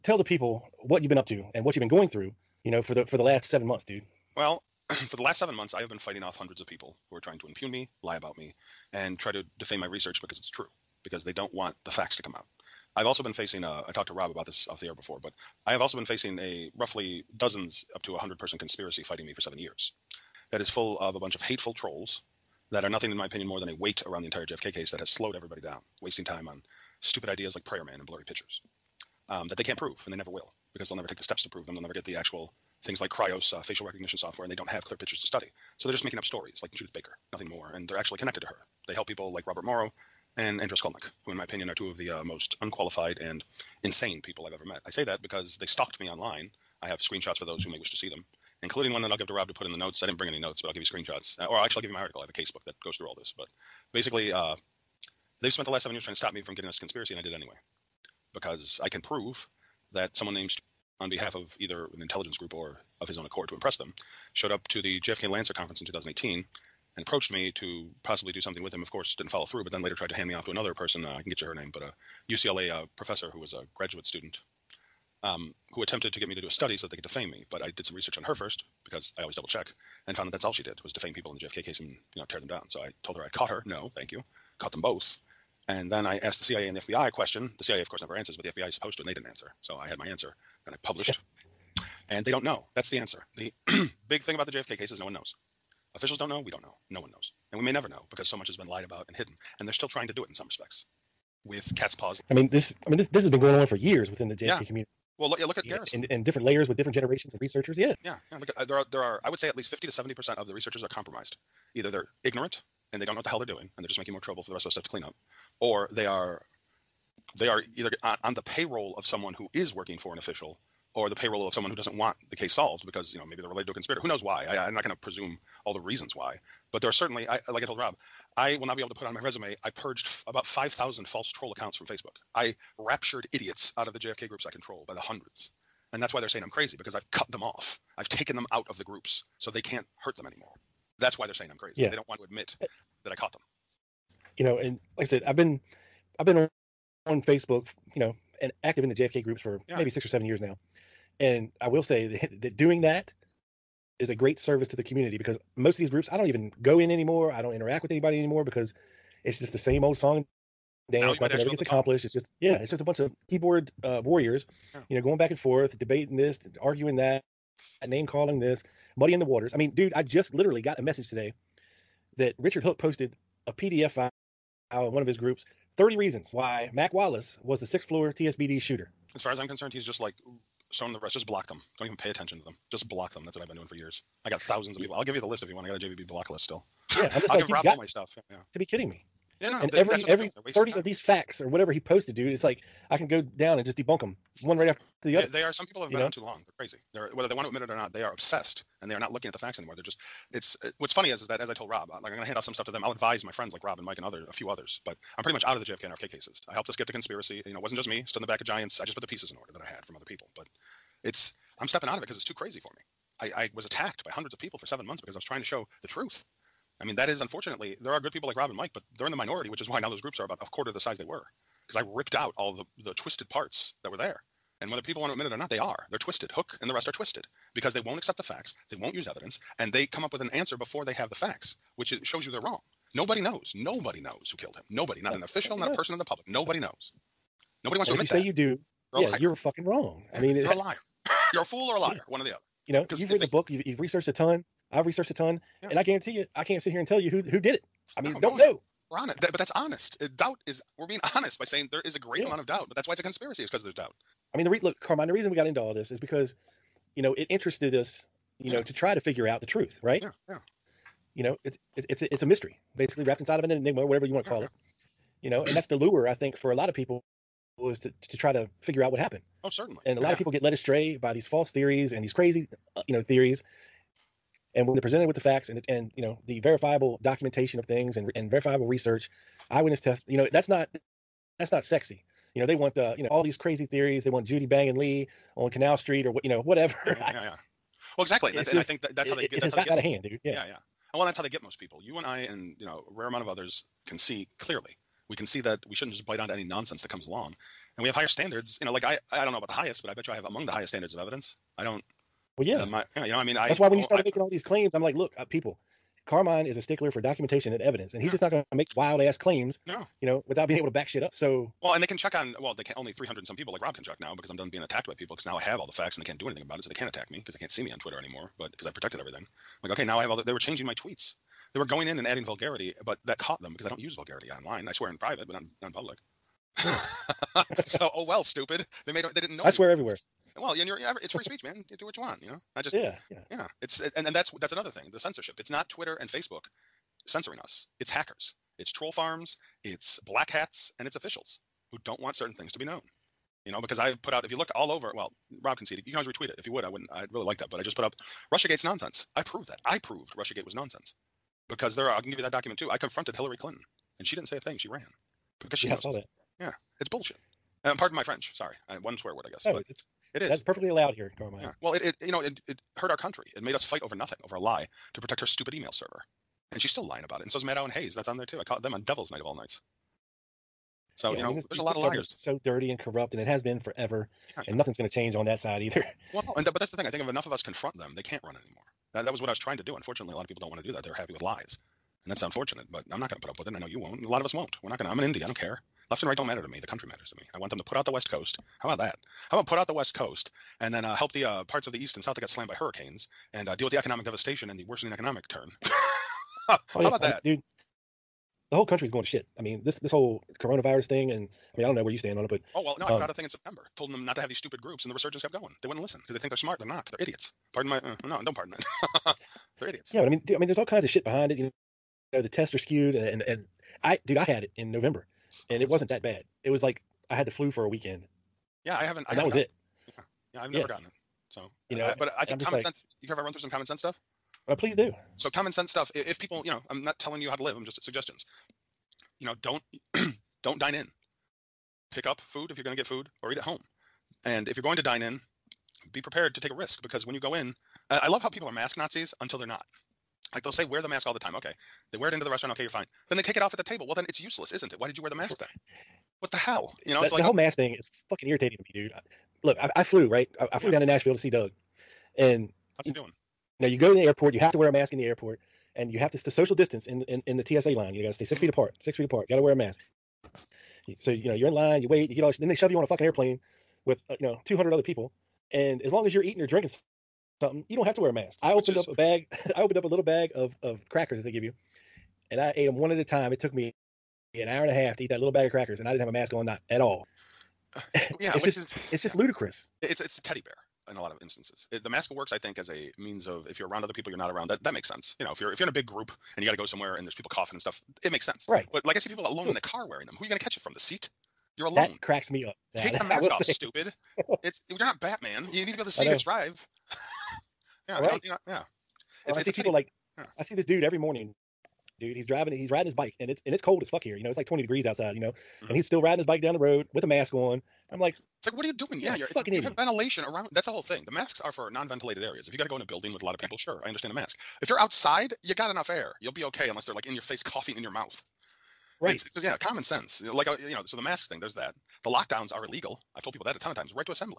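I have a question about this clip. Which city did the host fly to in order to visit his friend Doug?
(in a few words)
Nashville.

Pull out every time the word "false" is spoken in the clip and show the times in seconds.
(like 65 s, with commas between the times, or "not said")
131 s, 271 s.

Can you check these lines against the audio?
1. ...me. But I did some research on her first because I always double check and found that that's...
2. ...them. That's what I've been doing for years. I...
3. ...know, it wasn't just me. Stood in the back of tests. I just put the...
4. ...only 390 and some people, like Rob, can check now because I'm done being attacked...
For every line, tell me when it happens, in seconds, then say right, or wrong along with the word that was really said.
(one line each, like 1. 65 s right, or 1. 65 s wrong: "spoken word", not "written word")
1. 77 s right
2. 183 s right
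3. 207 s wrong: "giants", not "tests"
4. 312 s wrong: "300", not "390".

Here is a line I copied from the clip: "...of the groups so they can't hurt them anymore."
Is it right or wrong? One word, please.
right.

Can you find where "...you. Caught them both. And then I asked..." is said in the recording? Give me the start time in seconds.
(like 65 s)
84 s.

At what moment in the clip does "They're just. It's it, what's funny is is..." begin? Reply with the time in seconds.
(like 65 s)
199 s.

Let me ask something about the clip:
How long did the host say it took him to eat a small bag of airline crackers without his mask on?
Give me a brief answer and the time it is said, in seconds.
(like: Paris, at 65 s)
an hour and a half, at 474 s.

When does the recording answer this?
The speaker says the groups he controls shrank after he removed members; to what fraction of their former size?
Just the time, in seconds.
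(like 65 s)
220 s.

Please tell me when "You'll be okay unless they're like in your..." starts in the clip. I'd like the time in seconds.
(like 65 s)
516 s.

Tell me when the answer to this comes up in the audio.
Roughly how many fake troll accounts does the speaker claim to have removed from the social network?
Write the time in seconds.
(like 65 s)
130 s.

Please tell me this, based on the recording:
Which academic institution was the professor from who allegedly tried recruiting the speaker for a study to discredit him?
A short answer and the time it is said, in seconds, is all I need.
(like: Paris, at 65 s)
UCLA, at 72 s.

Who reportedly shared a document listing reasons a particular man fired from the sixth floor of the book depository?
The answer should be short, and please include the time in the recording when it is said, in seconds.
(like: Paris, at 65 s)
Richard Hook, at 172 s.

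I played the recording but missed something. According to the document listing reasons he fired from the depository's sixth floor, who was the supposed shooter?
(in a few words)
Mac Wallace.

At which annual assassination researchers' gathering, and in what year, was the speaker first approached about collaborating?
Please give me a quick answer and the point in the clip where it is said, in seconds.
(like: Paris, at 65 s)
JFK Lancer conference 2018, at 65 s.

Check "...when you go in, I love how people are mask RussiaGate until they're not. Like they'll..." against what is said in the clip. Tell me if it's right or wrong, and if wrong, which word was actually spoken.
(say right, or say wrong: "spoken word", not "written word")
wrong: "Nazis", not "RussiaGate".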